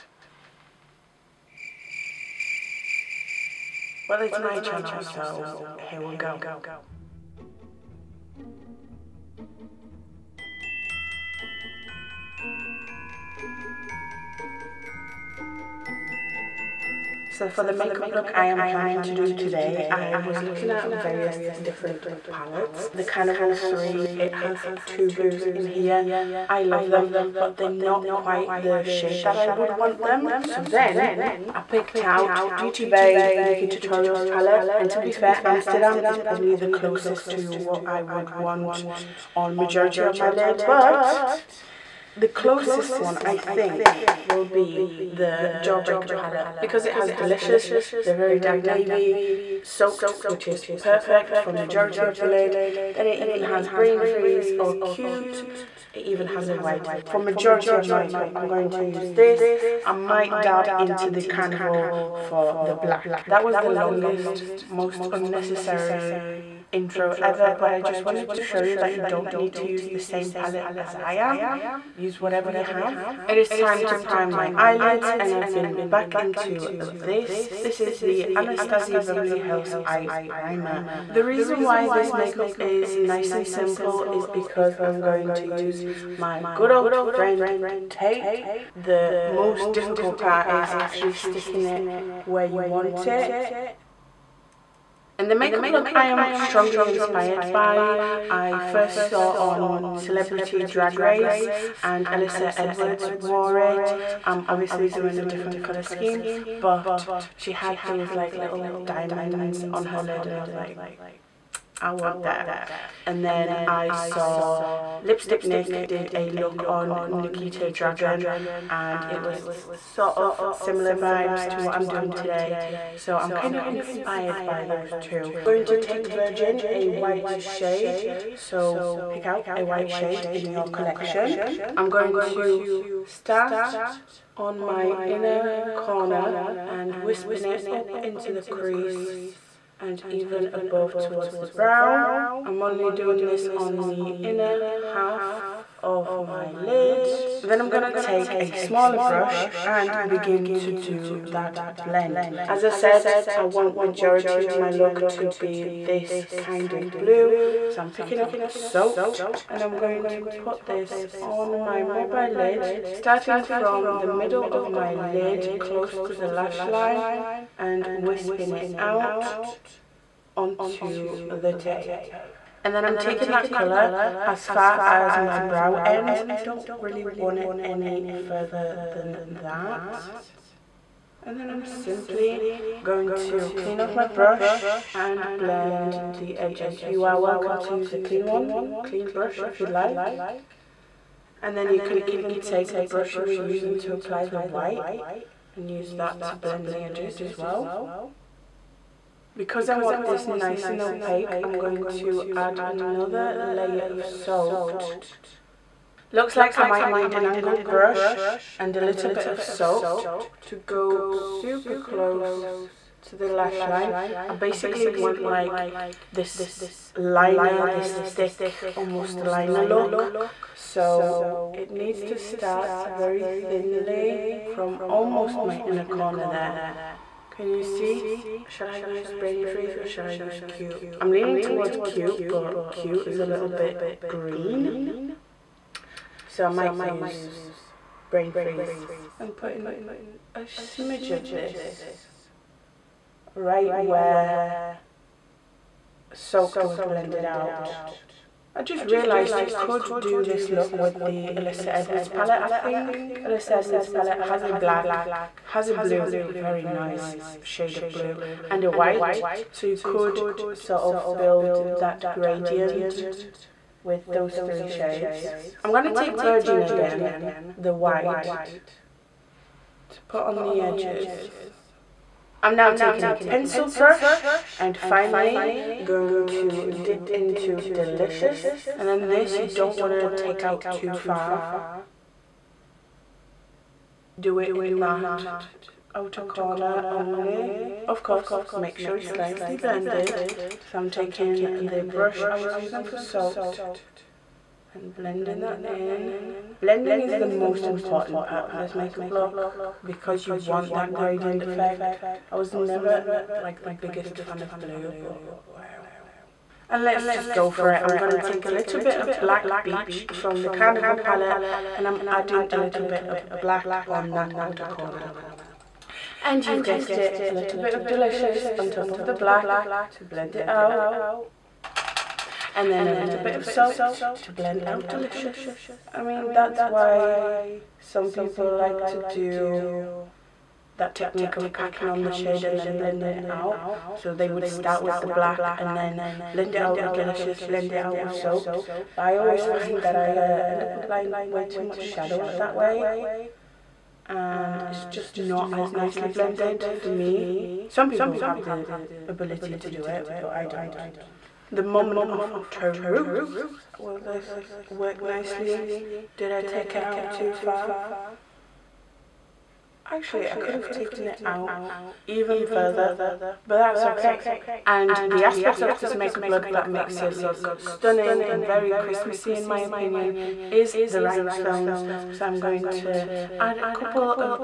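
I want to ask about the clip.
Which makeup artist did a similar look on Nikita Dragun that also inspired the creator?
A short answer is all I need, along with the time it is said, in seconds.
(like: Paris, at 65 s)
Lipstick Nick, at 114 s.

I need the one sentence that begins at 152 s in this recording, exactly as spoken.
As I said, I want majority of my look to be this kind of blue.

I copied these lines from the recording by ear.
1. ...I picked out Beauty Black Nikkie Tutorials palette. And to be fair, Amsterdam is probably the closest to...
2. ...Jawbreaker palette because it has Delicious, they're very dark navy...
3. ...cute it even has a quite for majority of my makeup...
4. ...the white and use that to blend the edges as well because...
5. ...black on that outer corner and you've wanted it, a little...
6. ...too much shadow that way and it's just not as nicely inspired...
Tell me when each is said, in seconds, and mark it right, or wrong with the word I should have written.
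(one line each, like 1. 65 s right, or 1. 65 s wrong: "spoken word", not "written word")
1. 31 s wrong: "Bay", not "Black"
2. 45 s right
3. 54 s wrong: "white", not "quite"
4. 194 s right
5. 313 s wrong: "guessed", not "wanted"
6. 341 s wrong: "blended", not "inspired".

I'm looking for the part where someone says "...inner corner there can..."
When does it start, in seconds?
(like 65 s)
225 s.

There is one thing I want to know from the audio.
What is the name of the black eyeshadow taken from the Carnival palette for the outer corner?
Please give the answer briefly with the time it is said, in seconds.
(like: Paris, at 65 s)
Black Beach, at 309 s.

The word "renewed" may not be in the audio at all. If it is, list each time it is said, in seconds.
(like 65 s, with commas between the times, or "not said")
not said.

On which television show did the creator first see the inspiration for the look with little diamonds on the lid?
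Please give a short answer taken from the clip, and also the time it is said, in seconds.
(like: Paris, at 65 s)
Celebrity Drag Race, at 99 s.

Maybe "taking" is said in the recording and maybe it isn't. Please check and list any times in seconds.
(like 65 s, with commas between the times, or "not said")
172 s, 272 s, 290 s.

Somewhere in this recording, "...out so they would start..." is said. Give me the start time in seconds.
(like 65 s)
333 s.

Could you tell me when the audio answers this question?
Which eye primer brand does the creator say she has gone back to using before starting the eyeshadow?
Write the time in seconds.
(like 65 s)
78 s.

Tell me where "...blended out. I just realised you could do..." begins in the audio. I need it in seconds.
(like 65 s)
246 s.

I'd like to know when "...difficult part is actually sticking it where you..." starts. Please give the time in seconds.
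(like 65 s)
89 s.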